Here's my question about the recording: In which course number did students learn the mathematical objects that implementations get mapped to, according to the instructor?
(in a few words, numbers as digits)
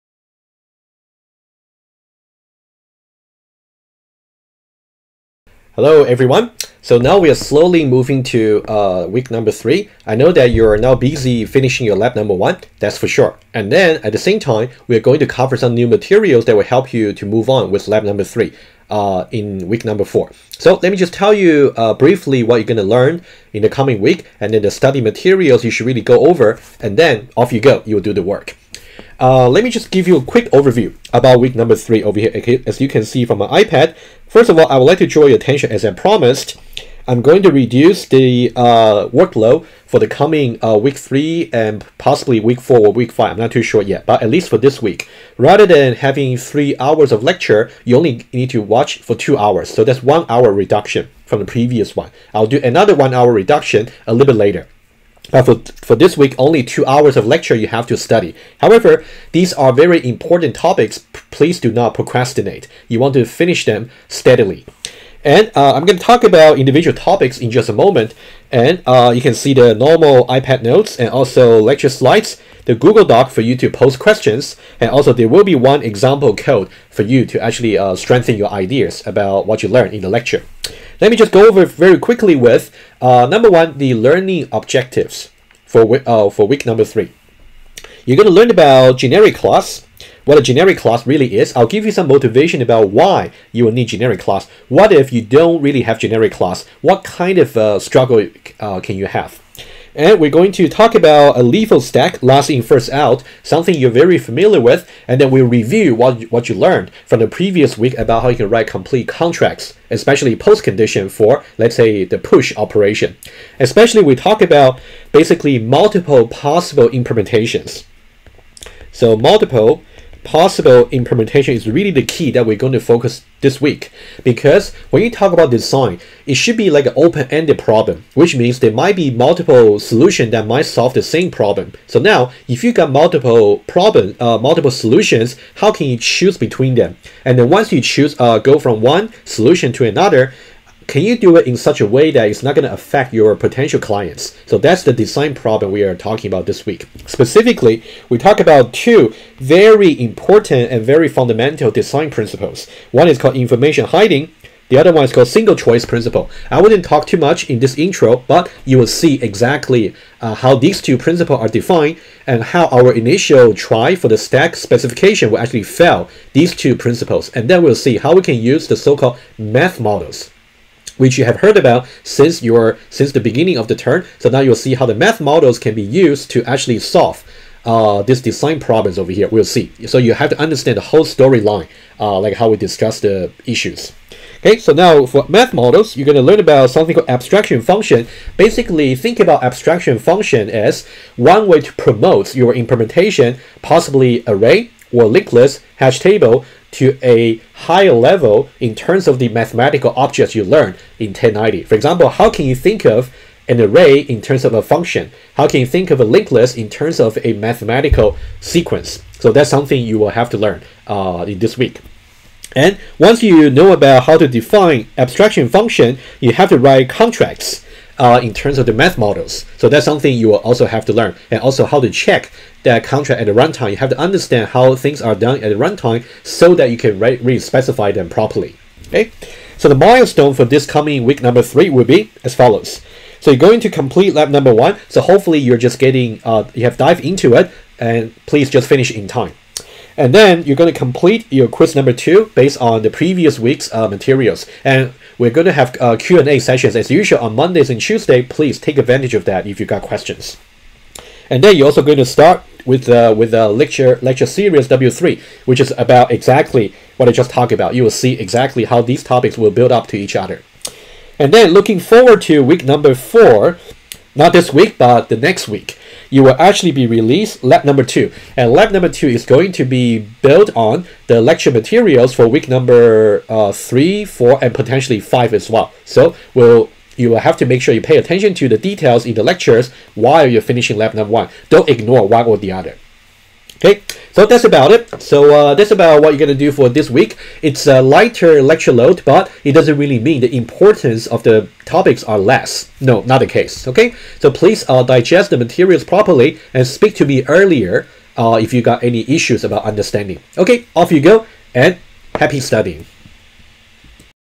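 1090.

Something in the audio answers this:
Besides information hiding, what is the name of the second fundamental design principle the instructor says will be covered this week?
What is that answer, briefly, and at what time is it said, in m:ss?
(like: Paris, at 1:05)
Single choice principle, at 2:35.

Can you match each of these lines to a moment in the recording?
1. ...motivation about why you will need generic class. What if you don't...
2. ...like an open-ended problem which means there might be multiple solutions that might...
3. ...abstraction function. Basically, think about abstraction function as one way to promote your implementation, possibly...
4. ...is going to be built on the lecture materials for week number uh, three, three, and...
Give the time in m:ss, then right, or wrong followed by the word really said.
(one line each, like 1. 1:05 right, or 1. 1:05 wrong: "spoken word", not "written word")
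1. 1:32 right
2. 2:06 right
3. 3:07 right
4. 4:29 wrong: "four", not "three".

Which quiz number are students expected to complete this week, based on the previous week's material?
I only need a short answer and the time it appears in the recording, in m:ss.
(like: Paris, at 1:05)
2, at 4:01.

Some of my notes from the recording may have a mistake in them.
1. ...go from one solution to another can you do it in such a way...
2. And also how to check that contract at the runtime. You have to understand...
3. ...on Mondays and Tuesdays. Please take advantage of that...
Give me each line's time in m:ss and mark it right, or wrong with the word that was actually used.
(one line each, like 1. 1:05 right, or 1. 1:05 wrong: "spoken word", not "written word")
1. 2:18 right
2. 3:41 right
3. 4:07 right.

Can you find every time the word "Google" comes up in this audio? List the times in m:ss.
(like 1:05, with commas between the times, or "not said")
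1:12.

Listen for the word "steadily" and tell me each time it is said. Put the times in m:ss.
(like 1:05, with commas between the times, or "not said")
1:04.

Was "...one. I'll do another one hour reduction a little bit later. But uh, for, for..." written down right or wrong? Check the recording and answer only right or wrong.
right.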